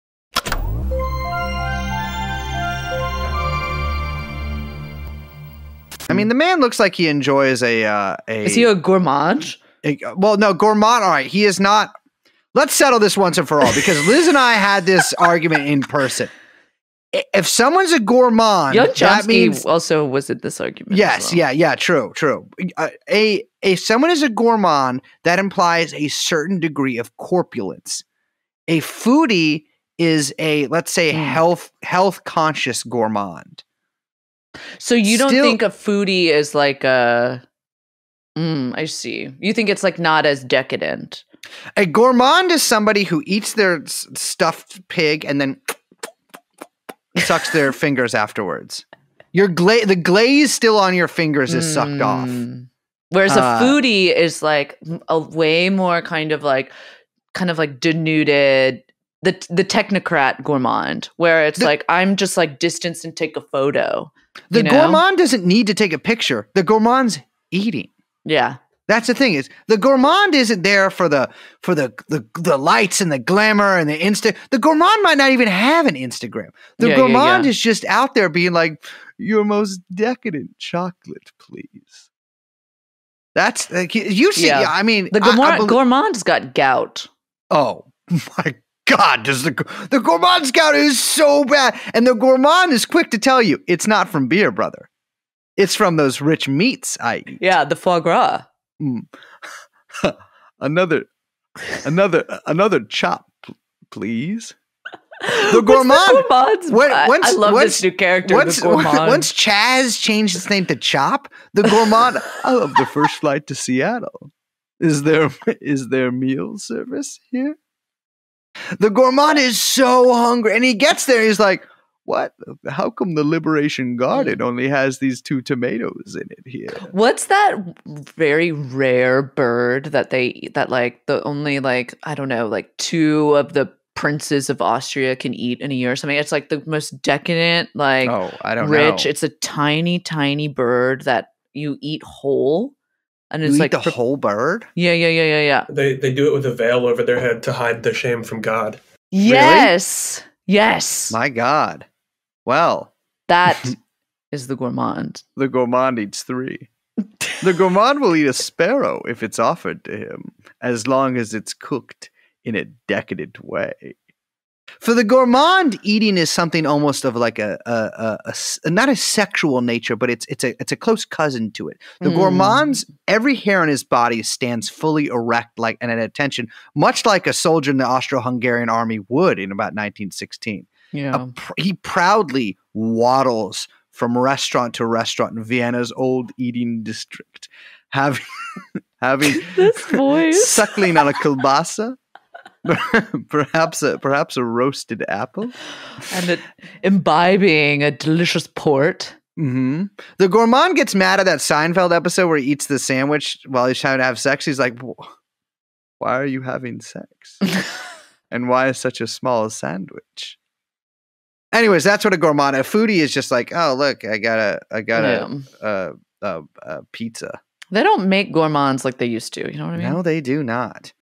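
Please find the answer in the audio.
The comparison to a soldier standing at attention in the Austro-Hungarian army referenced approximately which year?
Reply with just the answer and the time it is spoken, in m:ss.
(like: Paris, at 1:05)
1916, at 2:59.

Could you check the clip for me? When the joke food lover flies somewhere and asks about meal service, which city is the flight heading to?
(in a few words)
Seattle.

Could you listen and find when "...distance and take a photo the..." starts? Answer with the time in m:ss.
1:02.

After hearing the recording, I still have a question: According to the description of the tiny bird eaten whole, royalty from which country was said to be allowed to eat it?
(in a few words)
Austria.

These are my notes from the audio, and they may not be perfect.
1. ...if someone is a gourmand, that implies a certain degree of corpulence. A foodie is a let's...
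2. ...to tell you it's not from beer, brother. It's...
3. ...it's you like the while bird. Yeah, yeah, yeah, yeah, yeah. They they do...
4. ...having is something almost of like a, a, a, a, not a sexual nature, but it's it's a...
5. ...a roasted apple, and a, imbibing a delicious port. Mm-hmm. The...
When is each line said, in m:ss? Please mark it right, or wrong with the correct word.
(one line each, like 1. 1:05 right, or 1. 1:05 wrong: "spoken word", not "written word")
1. 0:23 right
2. 1:33 right
3. 2:23 wrong: "whole", not "while"
4. 2:45 wrong: "eating", not "having"
5. 3:14 right.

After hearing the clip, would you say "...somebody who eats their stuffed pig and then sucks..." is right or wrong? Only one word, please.
right.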